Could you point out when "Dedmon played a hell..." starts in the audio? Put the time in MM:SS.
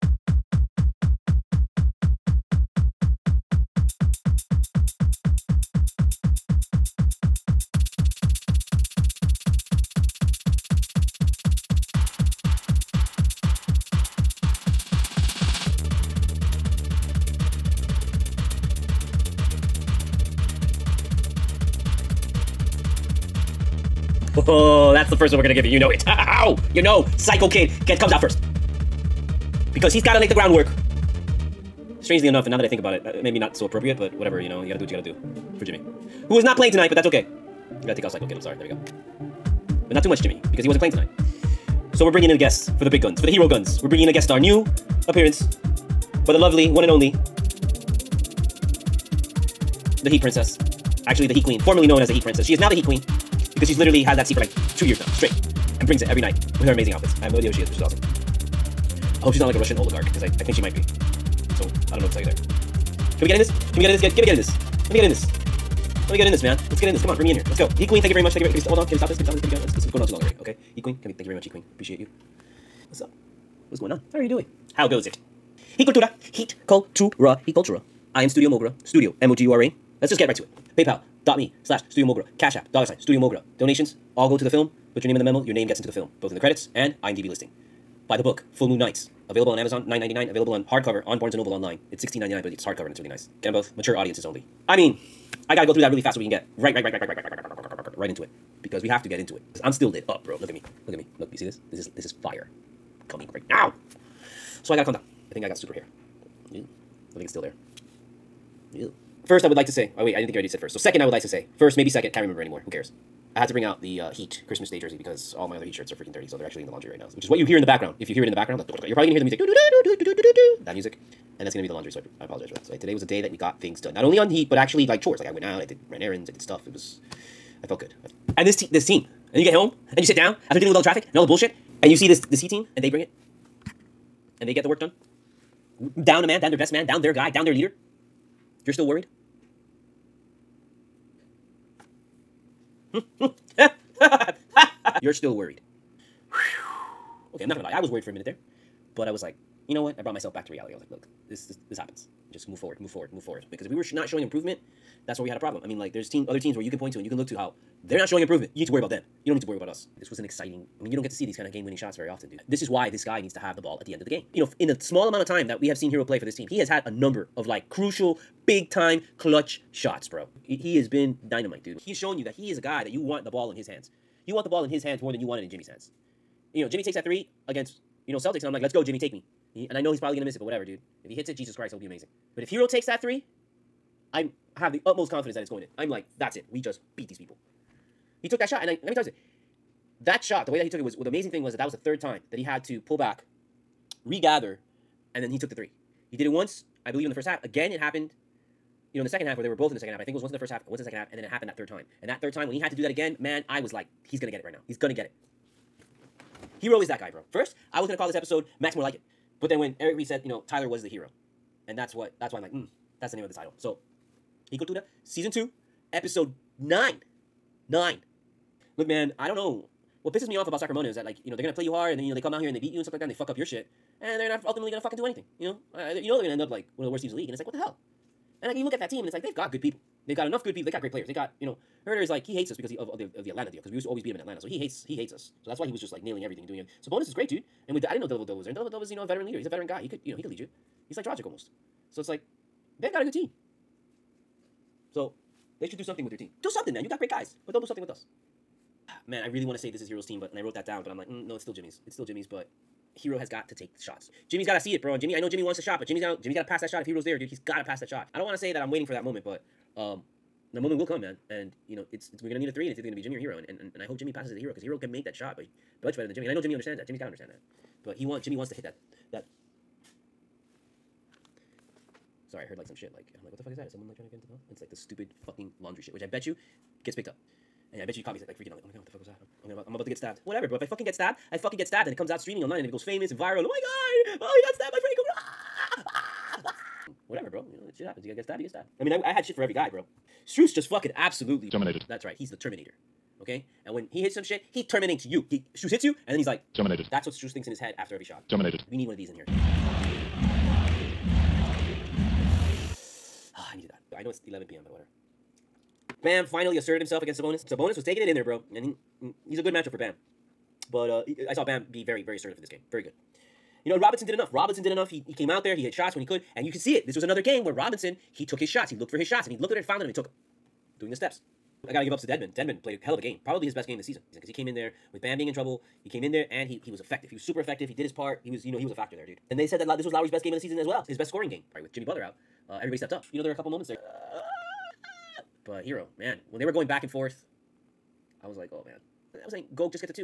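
05:22.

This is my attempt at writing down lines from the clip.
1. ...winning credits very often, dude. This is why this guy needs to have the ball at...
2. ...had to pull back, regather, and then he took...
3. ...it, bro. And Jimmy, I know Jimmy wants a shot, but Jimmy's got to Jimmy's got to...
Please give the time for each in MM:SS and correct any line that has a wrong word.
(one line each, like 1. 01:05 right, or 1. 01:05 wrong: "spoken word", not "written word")
1. 02:41 wrong: "shots", not "credits"
2. 03:12 right
3. 04:14 right.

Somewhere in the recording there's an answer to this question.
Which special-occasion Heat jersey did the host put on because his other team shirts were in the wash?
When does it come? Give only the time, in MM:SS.
01:54.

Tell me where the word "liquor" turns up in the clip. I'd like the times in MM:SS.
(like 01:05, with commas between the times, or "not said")
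not said.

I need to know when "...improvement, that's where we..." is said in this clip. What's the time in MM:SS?
02:34.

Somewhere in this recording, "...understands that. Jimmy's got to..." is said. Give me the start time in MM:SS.
04:26.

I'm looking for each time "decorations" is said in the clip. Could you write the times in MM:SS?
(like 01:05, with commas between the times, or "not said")
not said.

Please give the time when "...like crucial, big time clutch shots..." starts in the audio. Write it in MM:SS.
02:47.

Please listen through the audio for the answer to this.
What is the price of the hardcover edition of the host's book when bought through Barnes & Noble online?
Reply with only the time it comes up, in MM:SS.
01:32.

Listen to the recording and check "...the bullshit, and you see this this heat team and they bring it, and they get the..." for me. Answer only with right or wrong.
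right.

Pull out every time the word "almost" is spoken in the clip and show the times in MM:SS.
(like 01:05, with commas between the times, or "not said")
04:01.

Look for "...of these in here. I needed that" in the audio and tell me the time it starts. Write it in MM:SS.
04:58.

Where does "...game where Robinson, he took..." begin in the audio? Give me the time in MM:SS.
05:17.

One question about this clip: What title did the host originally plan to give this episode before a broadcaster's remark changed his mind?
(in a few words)
Max More Like It.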